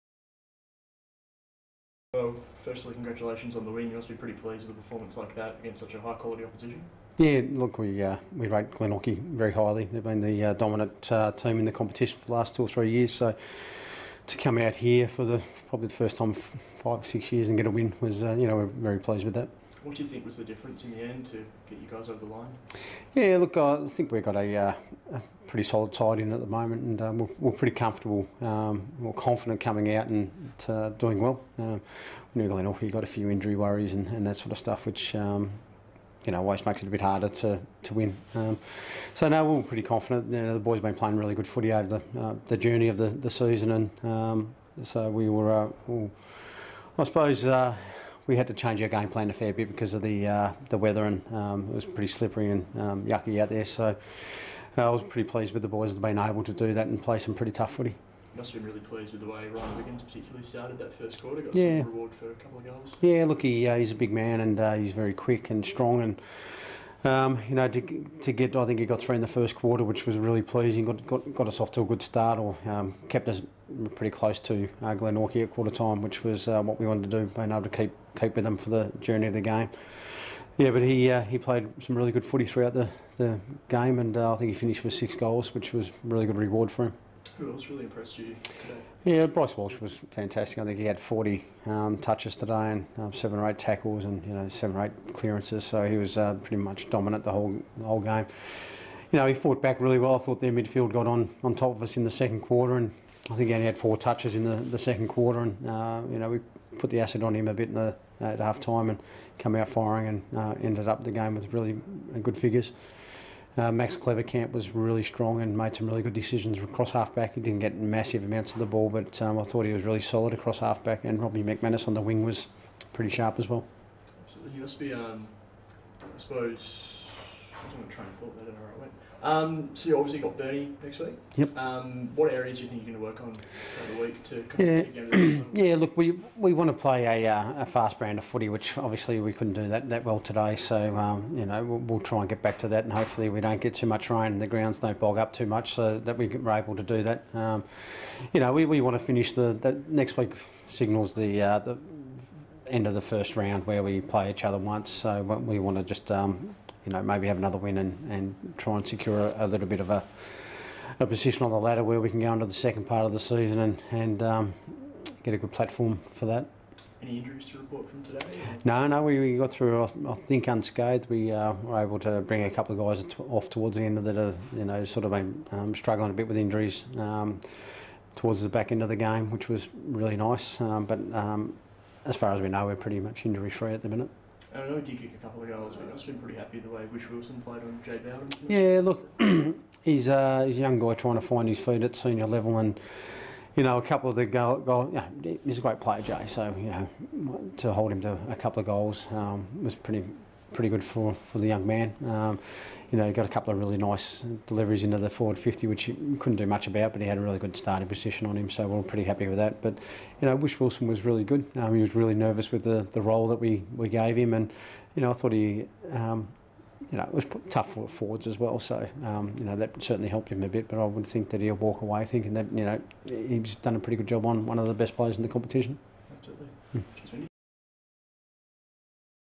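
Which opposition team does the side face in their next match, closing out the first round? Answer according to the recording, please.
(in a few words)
Burnie.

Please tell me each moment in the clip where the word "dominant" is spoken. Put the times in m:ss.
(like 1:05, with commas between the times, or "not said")
0:10, 1:36.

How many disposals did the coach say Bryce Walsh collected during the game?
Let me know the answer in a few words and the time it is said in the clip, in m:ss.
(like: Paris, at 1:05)
40, at 1:30.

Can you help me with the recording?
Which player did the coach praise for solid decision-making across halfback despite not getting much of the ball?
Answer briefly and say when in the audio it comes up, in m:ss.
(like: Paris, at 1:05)
Max Clevercamp, at 1:53.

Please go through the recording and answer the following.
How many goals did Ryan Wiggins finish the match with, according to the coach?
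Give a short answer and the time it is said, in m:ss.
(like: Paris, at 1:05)
6, at 1:24.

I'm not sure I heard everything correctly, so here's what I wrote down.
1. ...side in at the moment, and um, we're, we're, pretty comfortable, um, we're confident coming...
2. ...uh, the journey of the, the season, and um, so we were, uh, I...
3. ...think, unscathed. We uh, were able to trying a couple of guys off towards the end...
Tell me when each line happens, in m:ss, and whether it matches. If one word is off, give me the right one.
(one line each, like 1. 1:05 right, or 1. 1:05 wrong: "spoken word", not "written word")
1. 0:25 right
2. 0:42 right
3. 2:50 wrong: "bring", not "trying".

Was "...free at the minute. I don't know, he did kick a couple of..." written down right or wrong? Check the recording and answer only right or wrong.
right.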